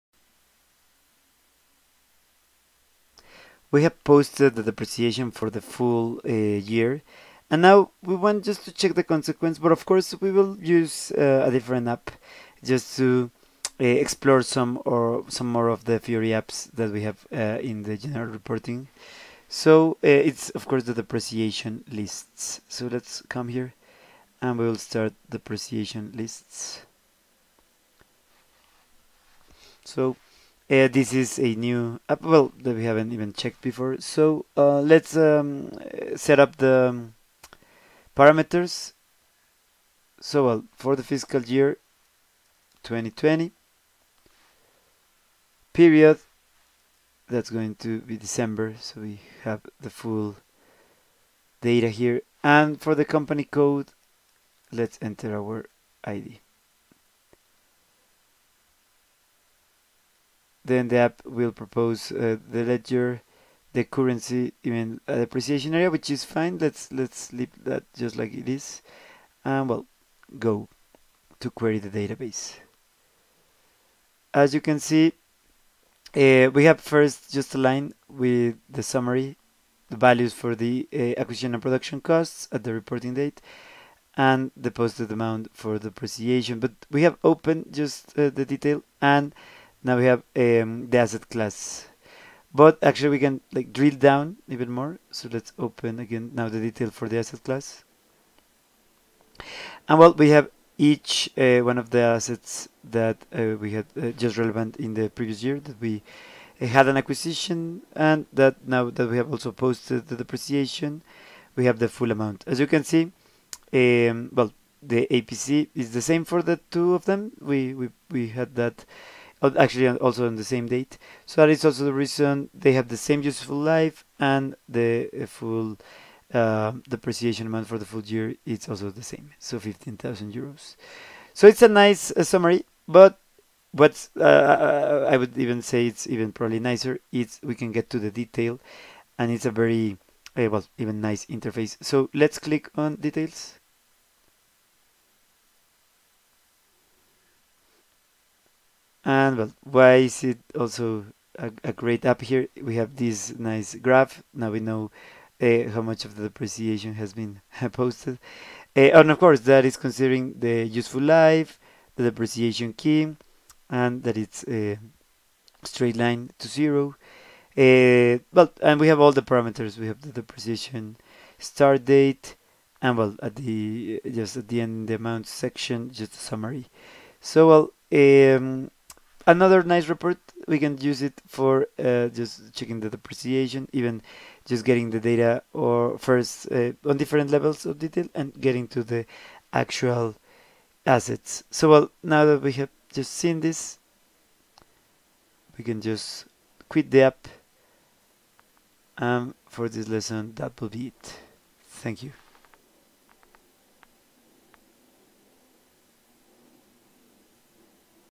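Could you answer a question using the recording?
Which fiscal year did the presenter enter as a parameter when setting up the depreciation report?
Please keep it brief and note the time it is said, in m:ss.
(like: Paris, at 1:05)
2020, at 0:42.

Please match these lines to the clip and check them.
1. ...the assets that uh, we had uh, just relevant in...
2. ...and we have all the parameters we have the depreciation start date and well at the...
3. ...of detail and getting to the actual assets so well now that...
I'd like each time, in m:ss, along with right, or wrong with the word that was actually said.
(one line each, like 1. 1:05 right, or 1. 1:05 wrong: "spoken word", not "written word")
1. 1:41 right
2. 2:48 right
3. 3:07 right.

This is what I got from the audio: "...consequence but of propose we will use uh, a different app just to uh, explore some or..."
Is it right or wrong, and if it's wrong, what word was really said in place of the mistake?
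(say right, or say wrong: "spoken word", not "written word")
wrong: "course", not "propose".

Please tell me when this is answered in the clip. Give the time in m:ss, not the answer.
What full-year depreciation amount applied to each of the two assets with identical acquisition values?
2:09.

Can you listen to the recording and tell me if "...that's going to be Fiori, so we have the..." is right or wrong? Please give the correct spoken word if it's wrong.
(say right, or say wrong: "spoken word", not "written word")
wrong: "December", not "Fiori".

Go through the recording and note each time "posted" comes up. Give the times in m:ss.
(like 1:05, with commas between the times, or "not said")
0:04, 1:24, 1:49, 2:37.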